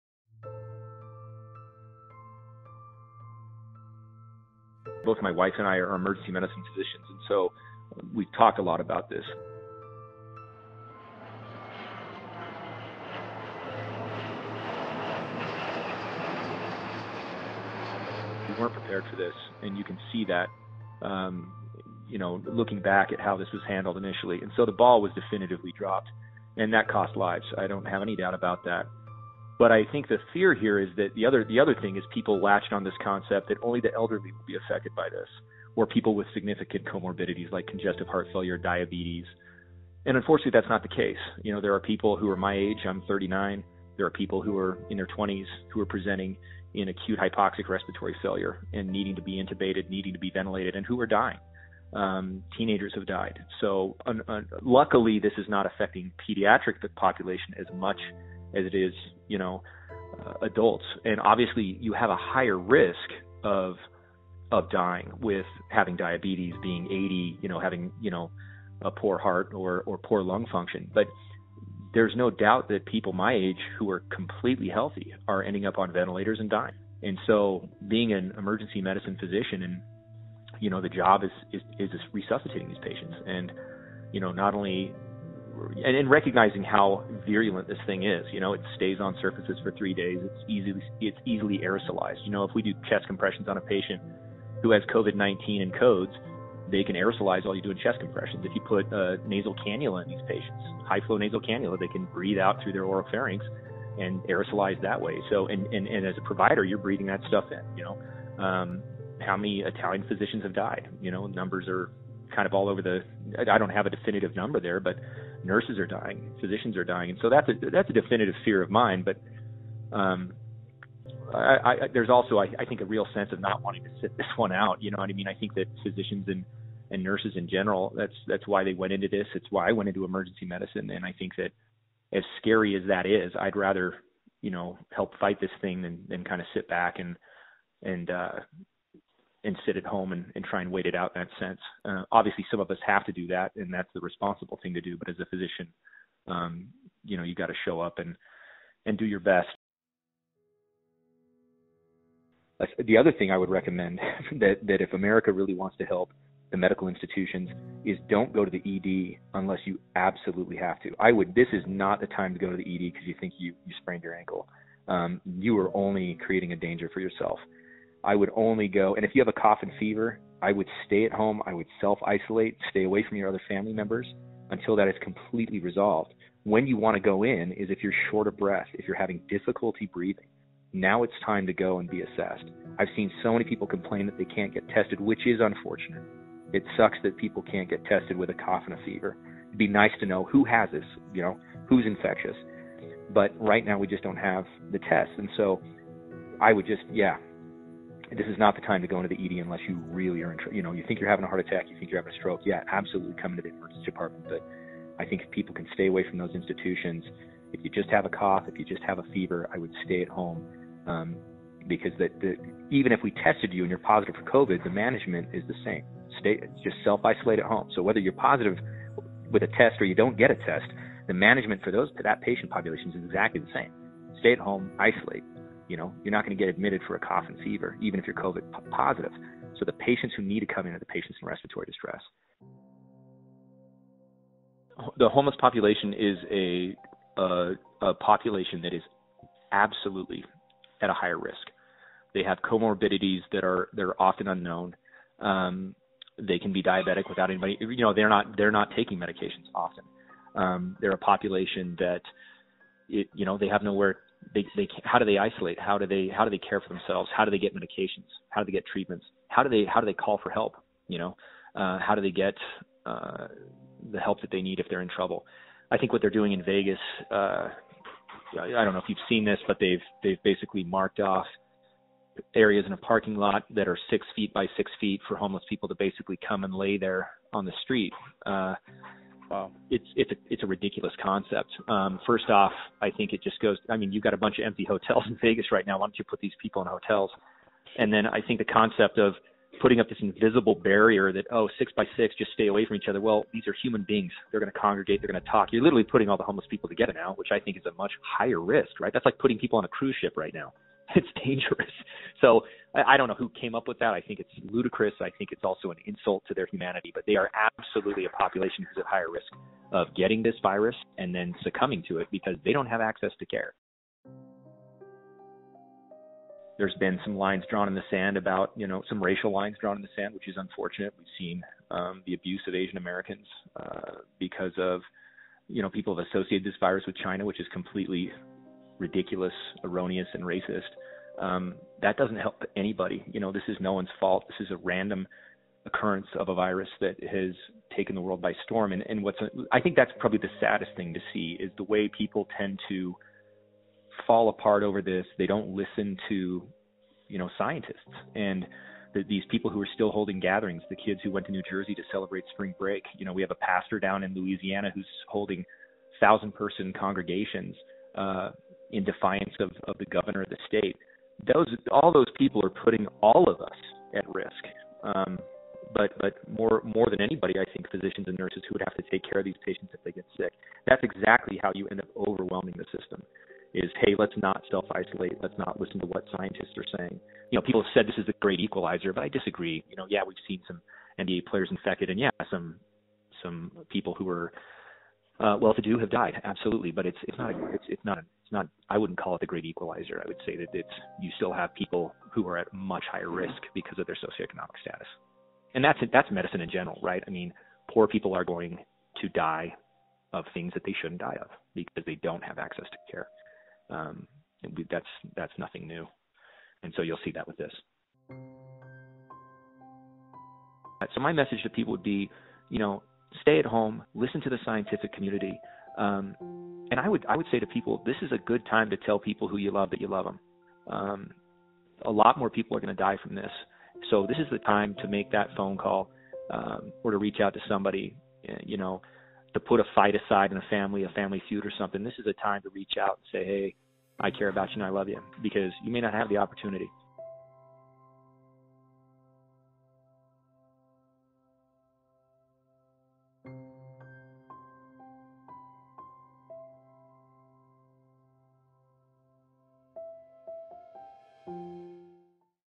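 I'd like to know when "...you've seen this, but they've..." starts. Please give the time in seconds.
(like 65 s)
268 s.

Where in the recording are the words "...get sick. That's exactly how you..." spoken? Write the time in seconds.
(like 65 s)
369 s.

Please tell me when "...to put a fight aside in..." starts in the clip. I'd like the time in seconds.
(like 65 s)
429 s.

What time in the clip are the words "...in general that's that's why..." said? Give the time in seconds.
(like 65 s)
127 s.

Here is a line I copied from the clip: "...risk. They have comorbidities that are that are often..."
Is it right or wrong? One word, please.
right.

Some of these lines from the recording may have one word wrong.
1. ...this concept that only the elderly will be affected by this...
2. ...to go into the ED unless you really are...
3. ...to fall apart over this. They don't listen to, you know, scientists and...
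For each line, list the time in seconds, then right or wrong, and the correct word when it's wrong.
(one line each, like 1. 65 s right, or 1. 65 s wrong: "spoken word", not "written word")
1. 32 s right
2. 198 s right
3. 342 s right.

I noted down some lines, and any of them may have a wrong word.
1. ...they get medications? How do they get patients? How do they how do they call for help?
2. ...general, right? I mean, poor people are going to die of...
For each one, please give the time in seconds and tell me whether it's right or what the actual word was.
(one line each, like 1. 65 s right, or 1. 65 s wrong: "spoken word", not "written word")
1. 257 s wrong: "treatments", not "patients"
2. 396 s right.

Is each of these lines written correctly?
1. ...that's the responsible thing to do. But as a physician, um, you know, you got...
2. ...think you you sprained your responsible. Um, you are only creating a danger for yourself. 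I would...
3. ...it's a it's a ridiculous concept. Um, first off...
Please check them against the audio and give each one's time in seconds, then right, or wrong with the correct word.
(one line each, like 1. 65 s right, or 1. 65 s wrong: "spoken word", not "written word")
1. 143 s right
2. 163 s wrong: "ankle", not "responsible"
3. 279 s right.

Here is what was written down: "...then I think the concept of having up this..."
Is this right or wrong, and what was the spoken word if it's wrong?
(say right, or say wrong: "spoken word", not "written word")
wrong: "putting", not "having".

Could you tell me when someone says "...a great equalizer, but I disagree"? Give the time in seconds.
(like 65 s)
378 s.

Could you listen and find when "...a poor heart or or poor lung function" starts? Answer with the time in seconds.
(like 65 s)
68 s.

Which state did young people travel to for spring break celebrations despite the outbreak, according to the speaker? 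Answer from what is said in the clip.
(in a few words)
New Jersey.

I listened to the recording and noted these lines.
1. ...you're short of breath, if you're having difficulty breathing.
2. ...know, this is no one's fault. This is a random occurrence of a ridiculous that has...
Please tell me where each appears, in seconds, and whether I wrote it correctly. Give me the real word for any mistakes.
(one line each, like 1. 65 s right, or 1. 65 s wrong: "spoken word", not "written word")
1. 177 s right
2. 333 s wrong: "virus", not "ridiculous".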